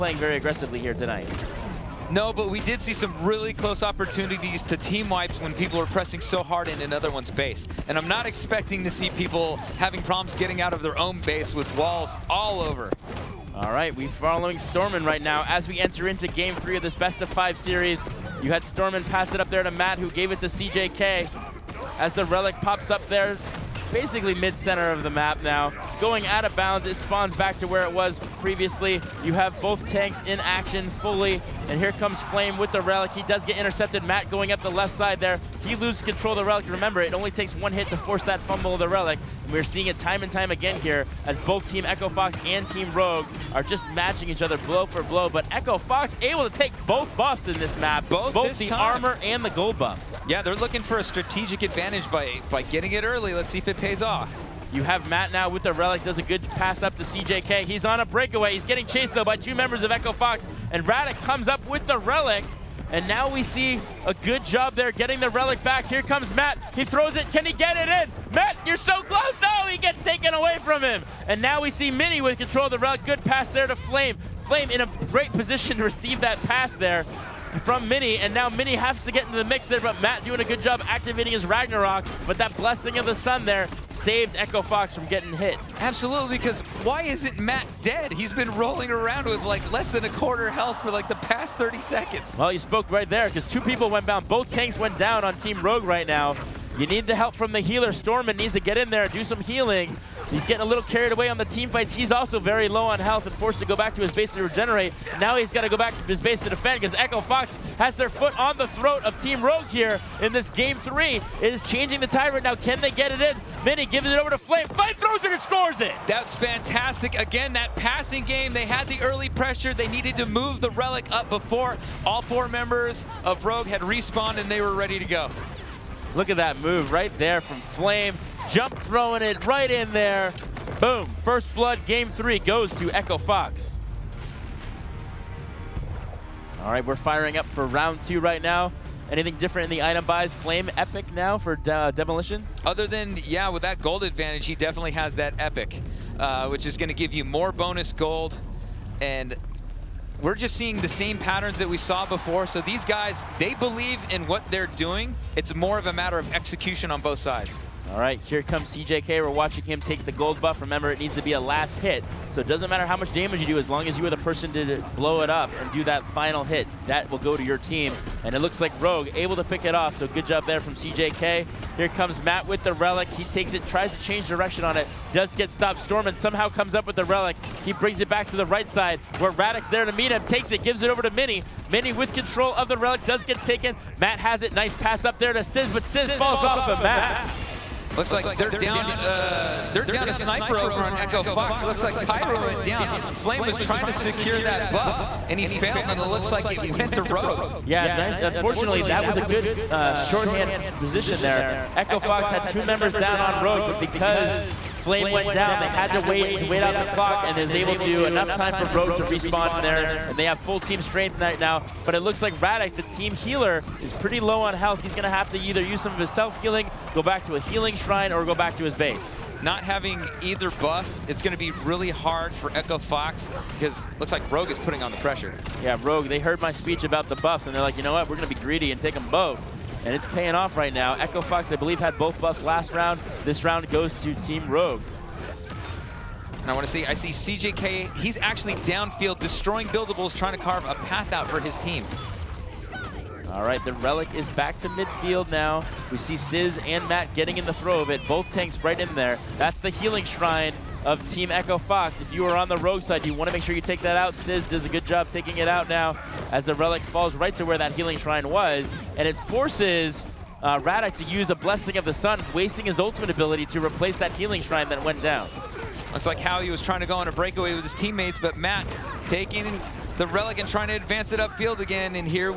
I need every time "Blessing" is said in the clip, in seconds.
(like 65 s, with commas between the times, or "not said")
82 s, 261 s.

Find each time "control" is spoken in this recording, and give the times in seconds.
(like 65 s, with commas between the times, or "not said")
36 s, 72 s, 182 s.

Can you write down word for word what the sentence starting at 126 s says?
Look at that move right there from Flame.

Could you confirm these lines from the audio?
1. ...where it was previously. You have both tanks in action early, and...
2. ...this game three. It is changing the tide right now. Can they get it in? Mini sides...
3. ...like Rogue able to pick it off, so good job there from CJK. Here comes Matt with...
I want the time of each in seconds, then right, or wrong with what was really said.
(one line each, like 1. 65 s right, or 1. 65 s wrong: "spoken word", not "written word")
1. 27 s wrong: "fully", not "early"
2. 110 s wrong: "gives", not "sides"
3. 168 s right.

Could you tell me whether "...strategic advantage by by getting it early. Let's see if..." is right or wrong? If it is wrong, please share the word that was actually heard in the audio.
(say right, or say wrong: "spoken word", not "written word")
right.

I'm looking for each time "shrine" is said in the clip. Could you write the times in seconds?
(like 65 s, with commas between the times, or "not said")
217 s, 250 s, 257 s, 264 s.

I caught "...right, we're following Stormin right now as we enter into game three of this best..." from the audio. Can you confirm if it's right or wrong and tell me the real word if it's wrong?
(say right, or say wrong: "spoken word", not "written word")
right.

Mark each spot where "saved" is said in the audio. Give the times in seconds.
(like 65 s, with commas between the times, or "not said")
83 s.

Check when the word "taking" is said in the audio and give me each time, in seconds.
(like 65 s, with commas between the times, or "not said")
255 s, 269 s.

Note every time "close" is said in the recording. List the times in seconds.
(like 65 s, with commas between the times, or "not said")
3 s, 69 s.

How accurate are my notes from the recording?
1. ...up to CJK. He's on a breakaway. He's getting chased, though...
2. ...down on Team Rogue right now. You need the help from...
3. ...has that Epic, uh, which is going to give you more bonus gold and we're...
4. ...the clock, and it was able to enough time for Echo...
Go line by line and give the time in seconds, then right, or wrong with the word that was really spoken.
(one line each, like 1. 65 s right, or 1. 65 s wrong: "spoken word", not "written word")
1. 56 s right
2. 94 s right
3. 144 s right
4. 206 s wrong: "Rogue", not "Echo".